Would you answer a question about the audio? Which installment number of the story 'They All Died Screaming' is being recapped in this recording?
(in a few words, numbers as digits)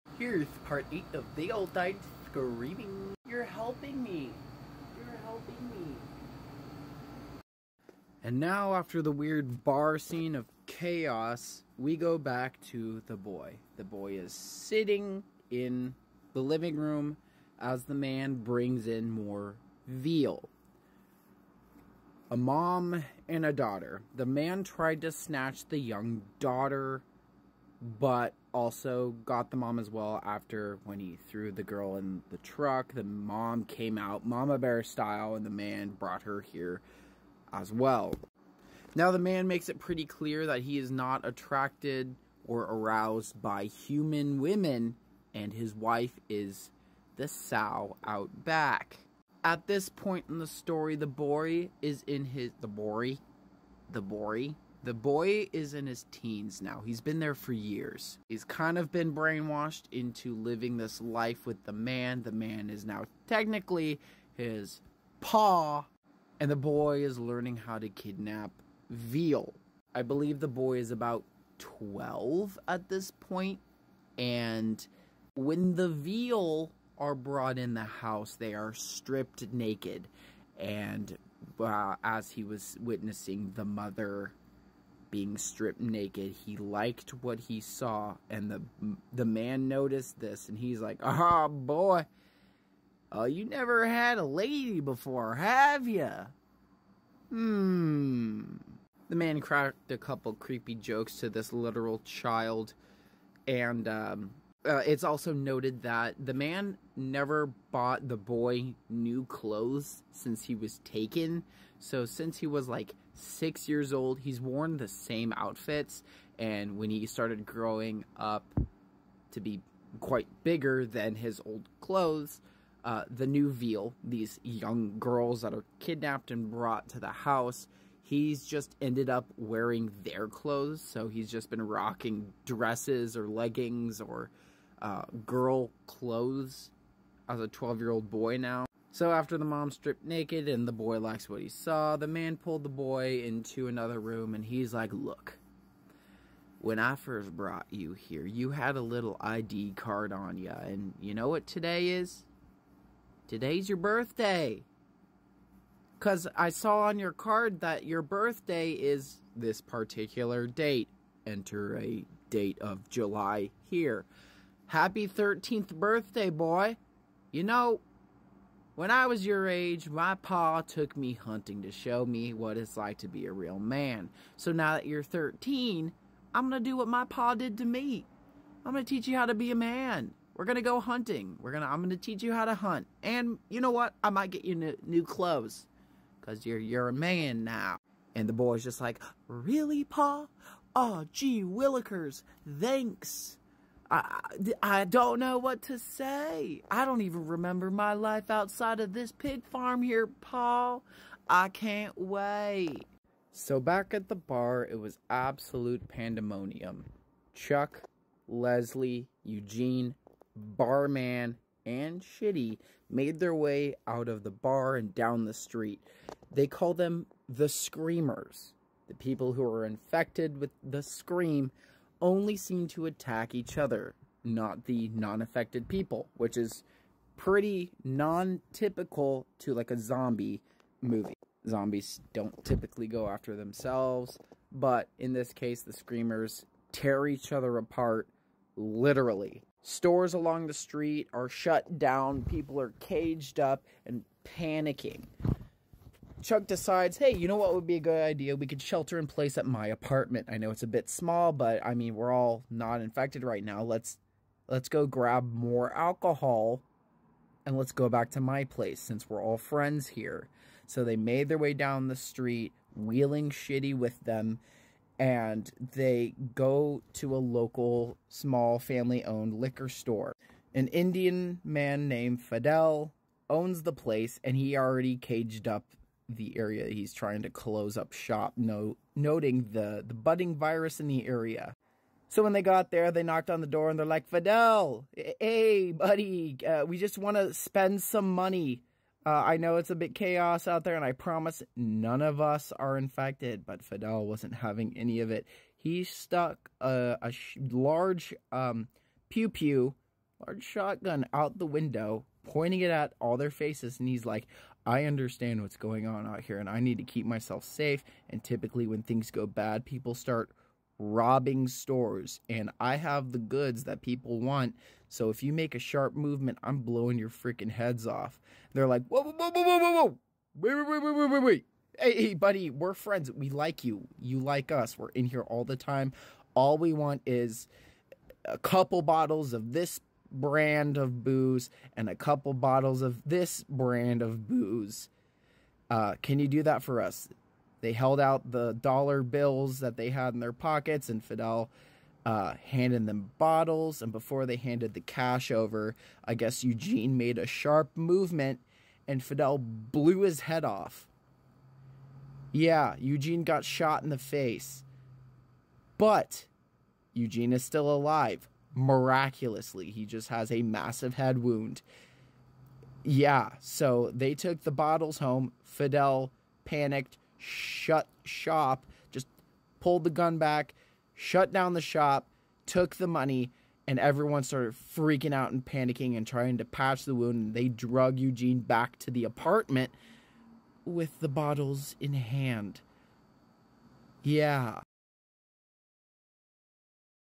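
8.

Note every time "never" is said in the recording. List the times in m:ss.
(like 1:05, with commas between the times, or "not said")
1:33, 1:46.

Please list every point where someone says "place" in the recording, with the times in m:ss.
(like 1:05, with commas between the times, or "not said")
4:09, 4:18, 4:33.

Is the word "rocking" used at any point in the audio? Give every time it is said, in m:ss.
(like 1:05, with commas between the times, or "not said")
2:11.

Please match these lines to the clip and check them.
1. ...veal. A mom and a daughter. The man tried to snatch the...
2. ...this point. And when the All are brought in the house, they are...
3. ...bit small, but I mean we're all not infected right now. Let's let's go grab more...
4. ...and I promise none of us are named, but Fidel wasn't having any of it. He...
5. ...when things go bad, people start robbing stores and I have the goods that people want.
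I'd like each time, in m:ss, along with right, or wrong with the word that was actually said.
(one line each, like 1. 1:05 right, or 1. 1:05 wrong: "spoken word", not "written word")
1. 0:19 right
2. 1:12 wrong: "Veal", not "All"
3. 4:10 right
4. 4:50 wrong: "infected", not "named"
5. 5:08 right.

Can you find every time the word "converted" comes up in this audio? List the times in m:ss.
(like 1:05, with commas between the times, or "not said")
not said.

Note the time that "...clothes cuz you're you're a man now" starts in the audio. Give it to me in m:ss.
3:05.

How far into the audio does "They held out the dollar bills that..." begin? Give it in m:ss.
5:37.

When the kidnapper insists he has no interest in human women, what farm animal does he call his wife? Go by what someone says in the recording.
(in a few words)
sow.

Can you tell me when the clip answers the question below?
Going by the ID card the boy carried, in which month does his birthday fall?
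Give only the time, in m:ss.
2:42.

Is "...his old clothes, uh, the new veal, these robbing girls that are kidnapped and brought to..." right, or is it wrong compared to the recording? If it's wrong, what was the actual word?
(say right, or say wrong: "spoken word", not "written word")
wrong: "young", not "robbing".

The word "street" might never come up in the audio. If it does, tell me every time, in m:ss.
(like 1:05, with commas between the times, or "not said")
3:35, 4:00, 4:21.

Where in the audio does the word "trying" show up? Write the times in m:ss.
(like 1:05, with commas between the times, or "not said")
4:36, 6:16.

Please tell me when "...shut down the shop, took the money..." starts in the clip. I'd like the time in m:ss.
6:10.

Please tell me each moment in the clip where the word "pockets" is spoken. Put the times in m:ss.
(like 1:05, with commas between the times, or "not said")
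5:40.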